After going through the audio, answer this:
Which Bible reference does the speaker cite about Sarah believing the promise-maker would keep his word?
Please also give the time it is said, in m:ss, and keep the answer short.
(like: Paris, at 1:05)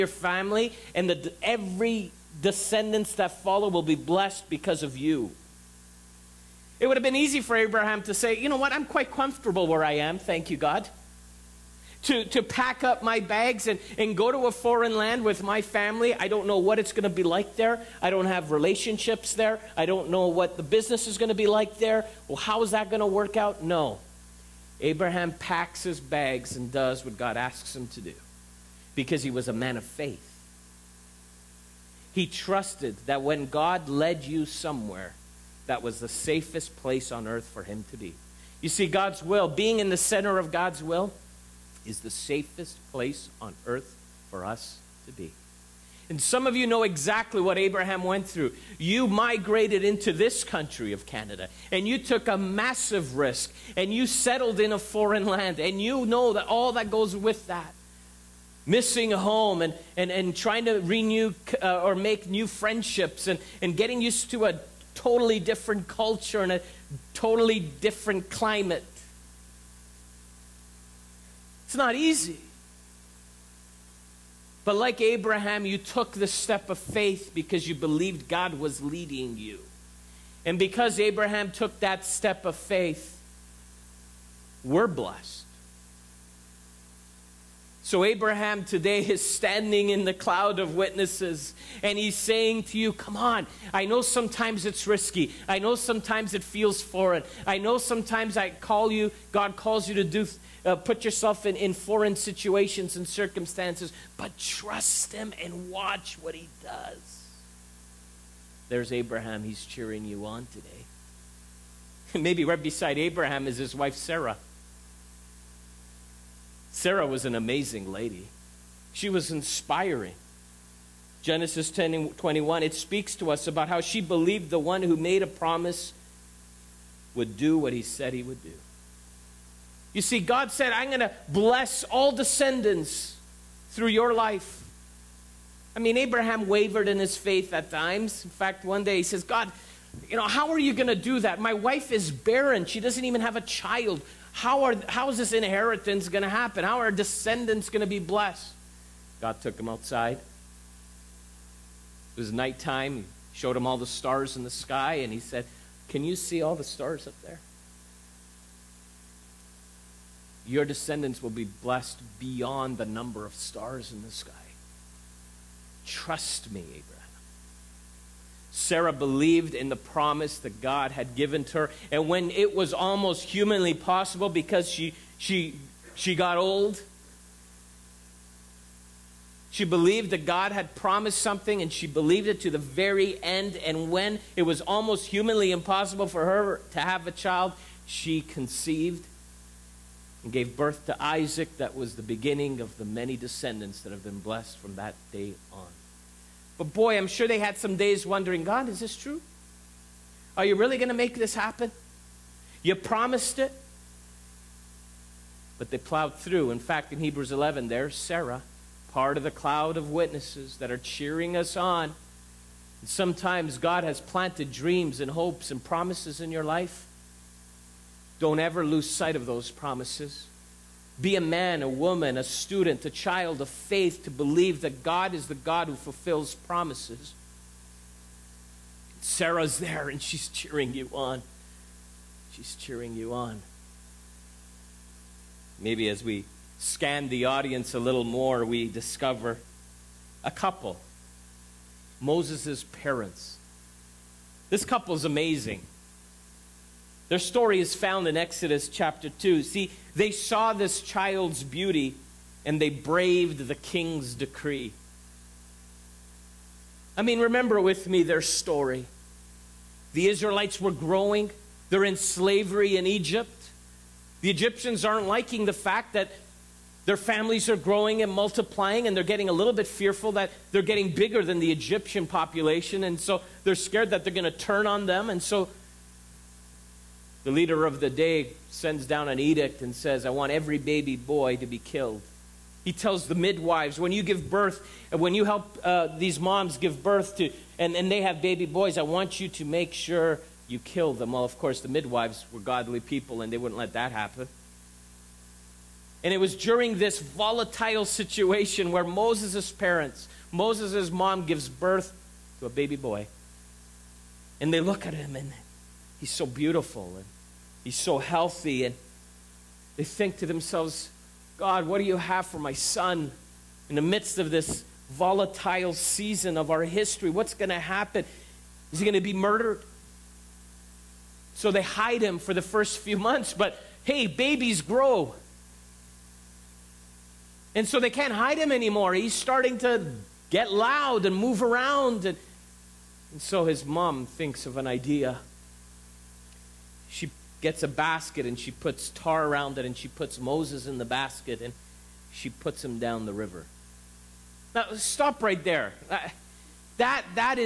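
Genesis 10 21, at 2:01.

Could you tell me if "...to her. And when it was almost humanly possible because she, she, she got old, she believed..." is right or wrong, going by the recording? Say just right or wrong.
right.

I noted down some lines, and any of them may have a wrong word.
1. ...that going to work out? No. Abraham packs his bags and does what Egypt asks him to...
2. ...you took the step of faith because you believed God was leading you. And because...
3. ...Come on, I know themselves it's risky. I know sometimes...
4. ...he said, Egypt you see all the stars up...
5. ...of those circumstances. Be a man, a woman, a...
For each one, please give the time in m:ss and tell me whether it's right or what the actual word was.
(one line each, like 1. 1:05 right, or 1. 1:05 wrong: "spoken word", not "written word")
1. 0:22 wrong: "God", not "Egypt"
2. 1:15 right
3. 1:32 wrong: "sometimes", not "themselves"
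4. 2:35 wrong: "Can", not "Egypt"
5. 3:39 wrong: "promises", not "circumstances".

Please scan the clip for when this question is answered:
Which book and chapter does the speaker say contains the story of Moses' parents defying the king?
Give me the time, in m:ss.
4:08.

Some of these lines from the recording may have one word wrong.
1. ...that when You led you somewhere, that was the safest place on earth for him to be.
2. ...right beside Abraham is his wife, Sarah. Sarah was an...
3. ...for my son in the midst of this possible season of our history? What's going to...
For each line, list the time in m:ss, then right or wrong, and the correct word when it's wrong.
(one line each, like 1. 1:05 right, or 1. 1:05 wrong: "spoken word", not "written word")
1. 0:33 wrong: "God", not "You"
2. 1:52 right
3. 5:12 wrong: "volatile", not "possible".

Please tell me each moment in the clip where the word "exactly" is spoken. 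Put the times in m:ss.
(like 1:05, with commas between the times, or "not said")
0:46.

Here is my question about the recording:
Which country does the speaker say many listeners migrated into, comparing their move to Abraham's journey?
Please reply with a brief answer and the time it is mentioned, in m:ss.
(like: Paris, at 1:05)
Canada, at 0:51.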